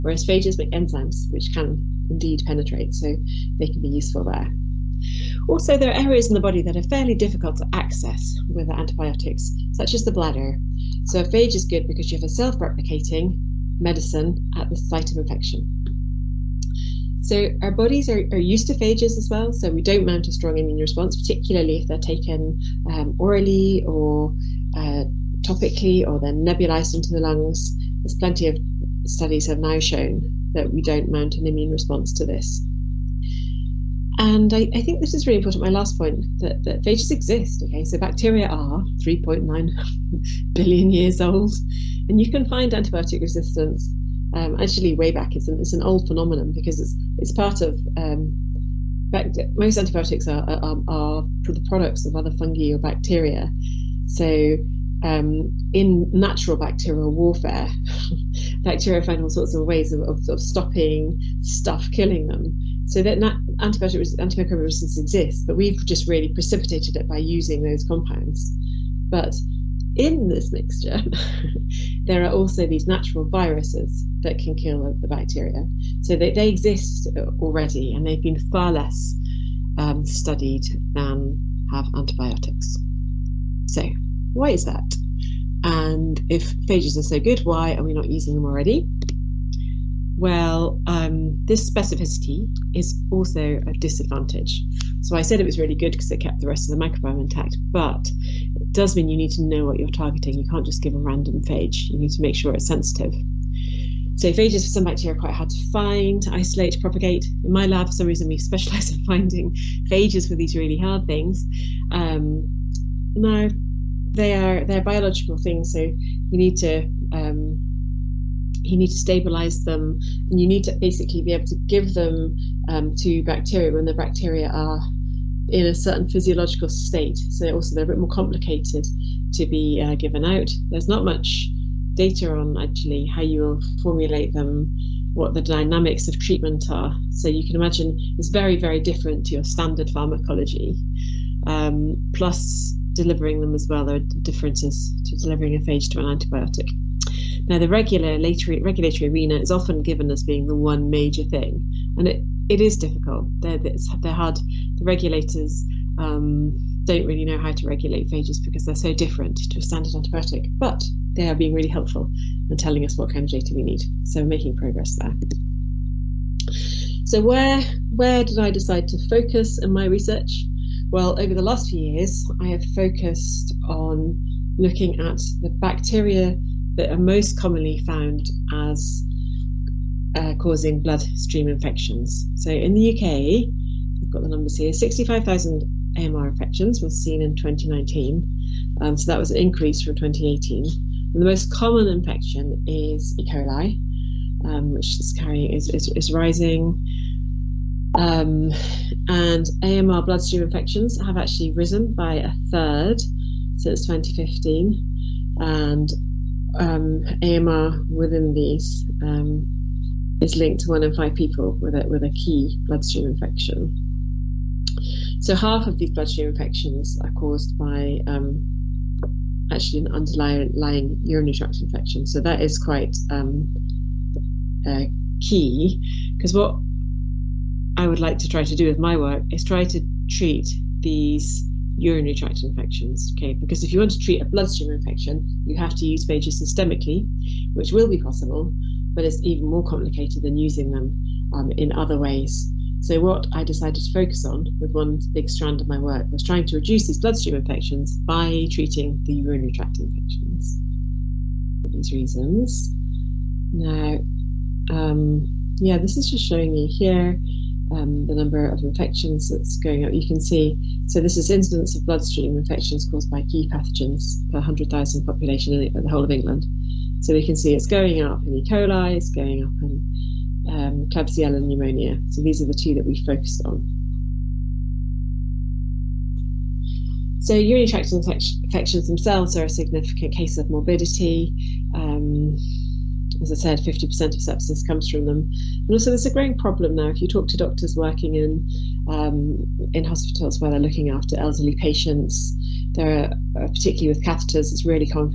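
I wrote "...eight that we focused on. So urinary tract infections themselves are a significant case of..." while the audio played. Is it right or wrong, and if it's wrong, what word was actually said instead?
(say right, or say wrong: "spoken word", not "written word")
wrong: "two", not "eight".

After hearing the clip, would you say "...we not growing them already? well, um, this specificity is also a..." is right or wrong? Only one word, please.
wrong.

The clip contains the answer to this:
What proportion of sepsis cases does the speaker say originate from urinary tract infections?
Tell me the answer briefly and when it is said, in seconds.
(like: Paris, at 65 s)
50%, at 283 s.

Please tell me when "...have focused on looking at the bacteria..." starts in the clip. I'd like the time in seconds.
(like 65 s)
172 s.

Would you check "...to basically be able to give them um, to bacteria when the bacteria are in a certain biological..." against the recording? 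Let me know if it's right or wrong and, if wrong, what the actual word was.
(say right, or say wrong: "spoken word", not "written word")
wrong: "physiological", not "biological".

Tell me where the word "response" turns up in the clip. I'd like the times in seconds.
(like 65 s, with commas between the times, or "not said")
20 s, 31 s.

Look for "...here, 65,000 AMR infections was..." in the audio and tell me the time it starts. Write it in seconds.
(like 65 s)
184 s.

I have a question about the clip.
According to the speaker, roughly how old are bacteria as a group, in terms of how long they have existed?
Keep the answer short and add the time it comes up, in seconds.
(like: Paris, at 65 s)
3.9 billion years, at 38 s.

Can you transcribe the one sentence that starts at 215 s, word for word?
So half of these bloodstream infections are caused by um, actually an underlying urinary tract infection.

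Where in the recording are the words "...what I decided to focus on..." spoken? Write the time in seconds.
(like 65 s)
242 s.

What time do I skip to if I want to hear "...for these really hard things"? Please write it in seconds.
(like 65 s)
110 s.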